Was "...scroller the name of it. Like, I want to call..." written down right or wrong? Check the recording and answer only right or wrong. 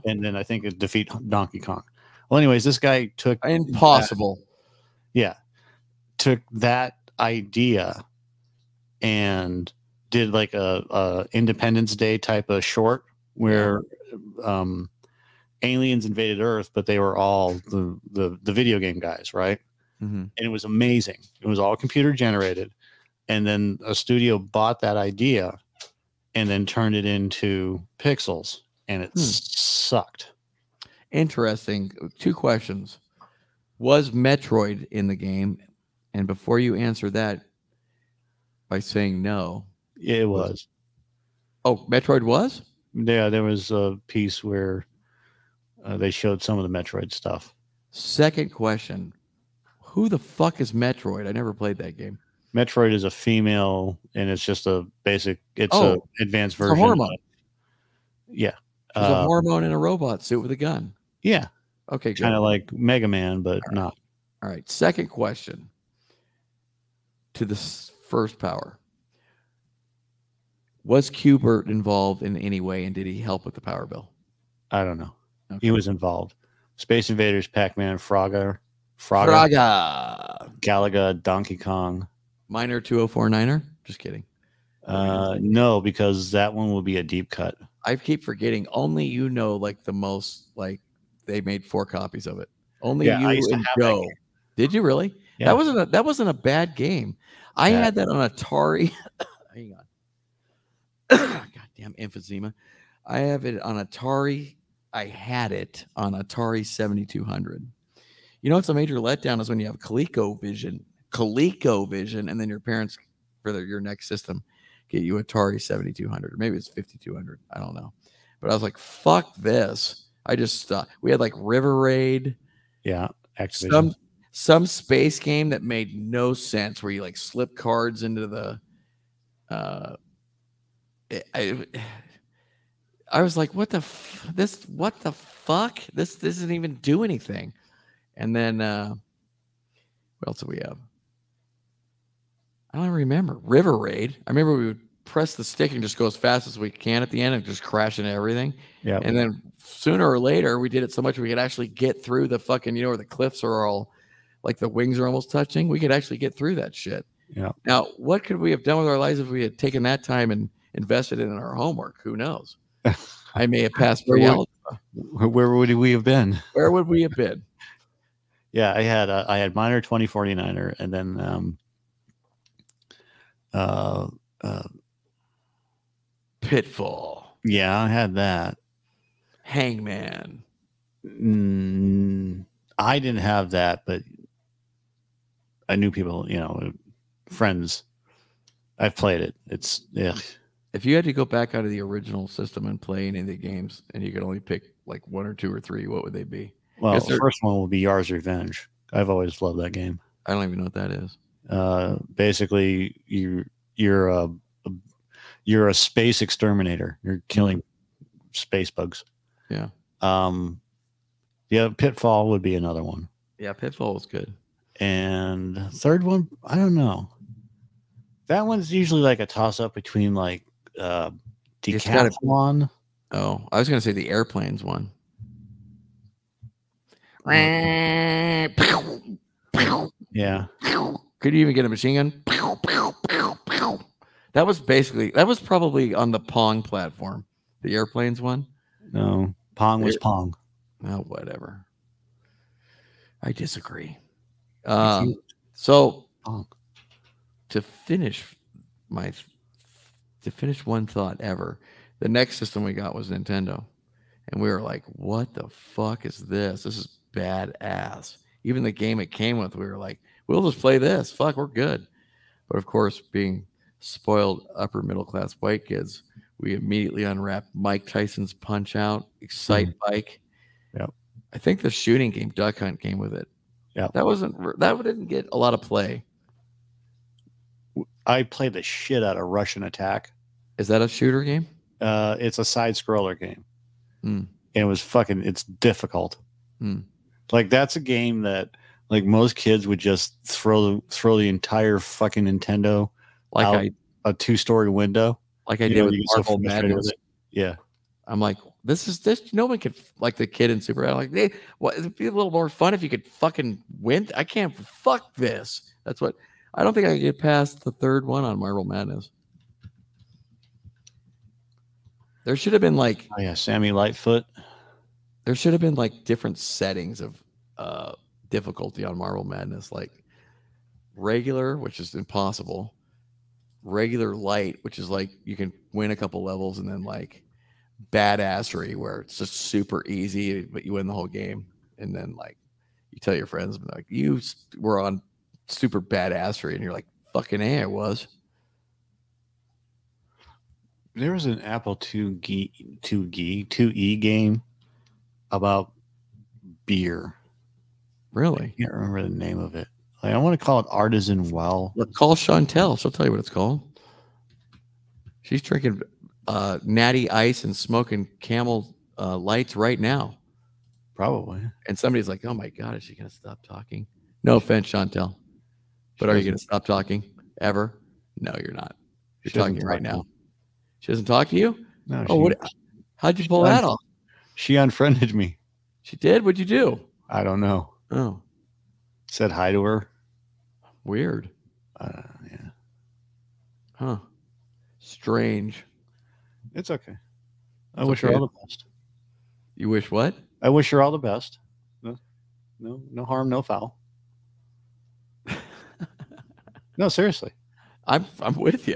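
wrong.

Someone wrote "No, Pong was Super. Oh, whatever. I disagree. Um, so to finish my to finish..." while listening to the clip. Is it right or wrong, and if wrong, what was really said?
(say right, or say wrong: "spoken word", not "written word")
wrong: "Pong", not "Super".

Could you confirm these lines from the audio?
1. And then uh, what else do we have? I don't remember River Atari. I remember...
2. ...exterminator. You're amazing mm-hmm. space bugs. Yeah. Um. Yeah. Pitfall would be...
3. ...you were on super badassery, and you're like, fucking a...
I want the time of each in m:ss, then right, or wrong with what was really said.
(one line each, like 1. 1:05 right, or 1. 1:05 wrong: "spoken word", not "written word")
1. 2:18 wrong: "Raid", not "Atari"
2. 3:26 wrong: "killing", not "amazing"
3. 5:33 right.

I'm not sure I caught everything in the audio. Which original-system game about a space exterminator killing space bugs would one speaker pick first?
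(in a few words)
Yar's Revenge.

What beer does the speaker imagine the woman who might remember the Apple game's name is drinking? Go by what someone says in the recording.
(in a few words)
Natty Ice.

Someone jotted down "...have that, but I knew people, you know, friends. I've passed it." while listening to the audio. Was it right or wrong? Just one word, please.
wrong.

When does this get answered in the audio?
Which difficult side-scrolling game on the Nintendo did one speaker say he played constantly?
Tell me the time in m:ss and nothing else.
4:39.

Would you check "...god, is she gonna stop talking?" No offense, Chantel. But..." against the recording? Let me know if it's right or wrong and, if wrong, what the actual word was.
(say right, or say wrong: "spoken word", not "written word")
right.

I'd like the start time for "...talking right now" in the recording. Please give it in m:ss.
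6:09.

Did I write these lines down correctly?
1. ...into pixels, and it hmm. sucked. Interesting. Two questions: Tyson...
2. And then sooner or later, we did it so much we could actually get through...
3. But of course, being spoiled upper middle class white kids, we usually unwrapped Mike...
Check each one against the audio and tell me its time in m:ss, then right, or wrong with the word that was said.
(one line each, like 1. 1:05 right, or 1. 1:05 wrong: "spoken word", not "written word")
1. 0:27 wrong: "Was", not "Tyson"
2. 2:29 right
3. 4:22 wrong: "immediately", not "usually".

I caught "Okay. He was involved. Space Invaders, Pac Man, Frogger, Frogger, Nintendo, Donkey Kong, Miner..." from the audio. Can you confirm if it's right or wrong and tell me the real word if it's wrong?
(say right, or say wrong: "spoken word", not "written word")
wrong: "Galaga", not "Nintendo".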